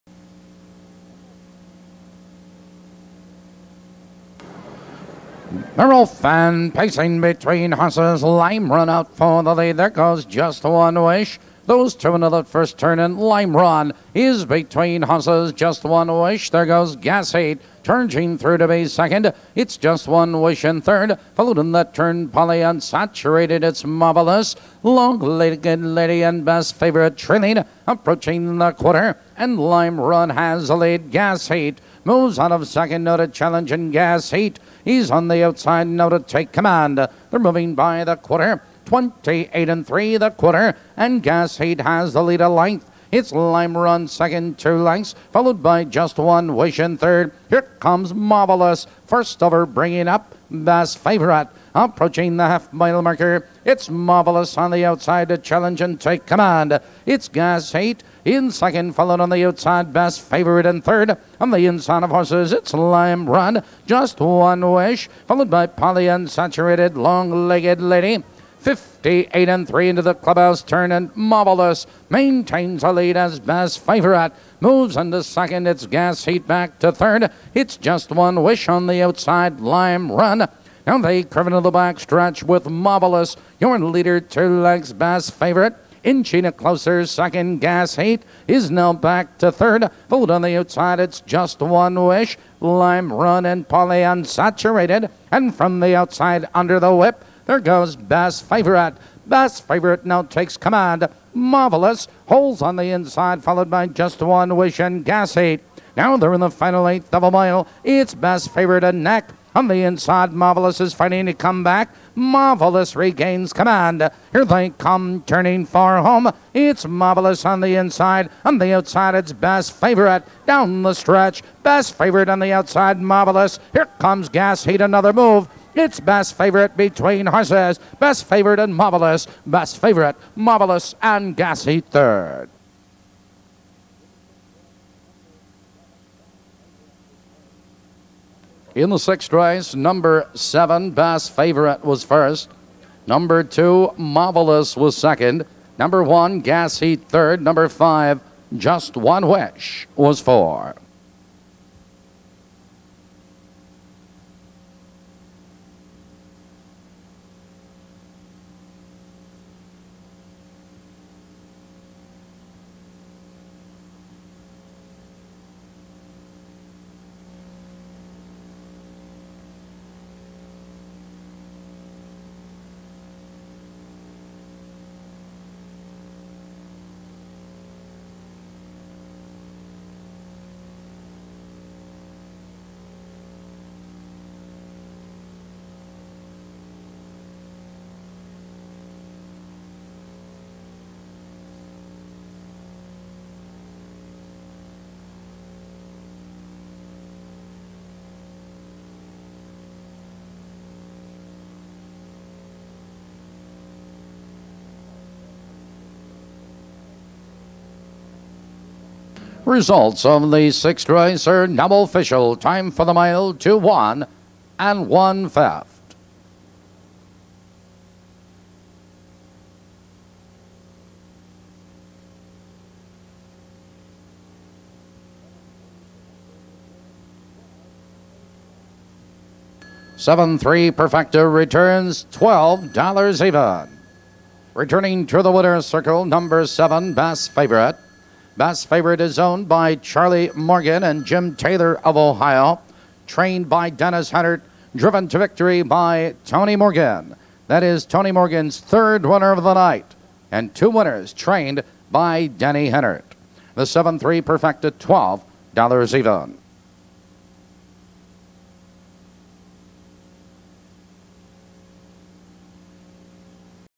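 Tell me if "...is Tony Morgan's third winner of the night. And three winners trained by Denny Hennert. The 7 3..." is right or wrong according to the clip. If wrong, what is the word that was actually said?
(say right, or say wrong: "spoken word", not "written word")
wrong: "two", not "three".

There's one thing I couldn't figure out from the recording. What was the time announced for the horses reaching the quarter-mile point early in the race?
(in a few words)
28 and 3.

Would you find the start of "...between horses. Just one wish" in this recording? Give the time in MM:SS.
00:14.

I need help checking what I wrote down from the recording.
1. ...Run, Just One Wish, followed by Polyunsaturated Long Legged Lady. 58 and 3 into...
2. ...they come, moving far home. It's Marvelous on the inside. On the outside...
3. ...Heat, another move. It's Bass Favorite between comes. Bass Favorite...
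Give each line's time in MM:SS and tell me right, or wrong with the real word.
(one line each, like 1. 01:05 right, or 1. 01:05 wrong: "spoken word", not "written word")
1. 01:03 right
2. 01:54 wrong: "turning", not "moving"
3. 02:04 wrong: "horses", not "comes".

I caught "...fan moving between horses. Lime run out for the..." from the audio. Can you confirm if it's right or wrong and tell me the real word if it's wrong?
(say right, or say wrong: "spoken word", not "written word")
wrong: "pacing", not "moving".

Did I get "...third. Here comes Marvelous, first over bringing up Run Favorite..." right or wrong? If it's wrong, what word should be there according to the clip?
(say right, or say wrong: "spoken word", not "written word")
wrong: "Bass", not "Run".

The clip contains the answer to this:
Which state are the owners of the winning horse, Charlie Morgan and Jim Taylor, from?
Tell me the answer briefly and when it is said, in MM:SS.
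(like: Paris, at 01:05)
Ohio, at 04:01.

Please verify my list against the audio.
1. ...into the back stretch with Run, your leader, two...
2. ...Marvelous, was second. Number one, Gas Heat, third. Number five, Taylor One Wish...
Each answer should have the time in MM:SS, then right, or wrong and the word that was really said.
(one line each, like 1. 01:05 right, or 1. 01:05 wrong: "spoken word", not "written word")
1. 01:21 wrong: "Marvelous", not "Run"
2. 02:23 wrong: "Just", not "Taylor".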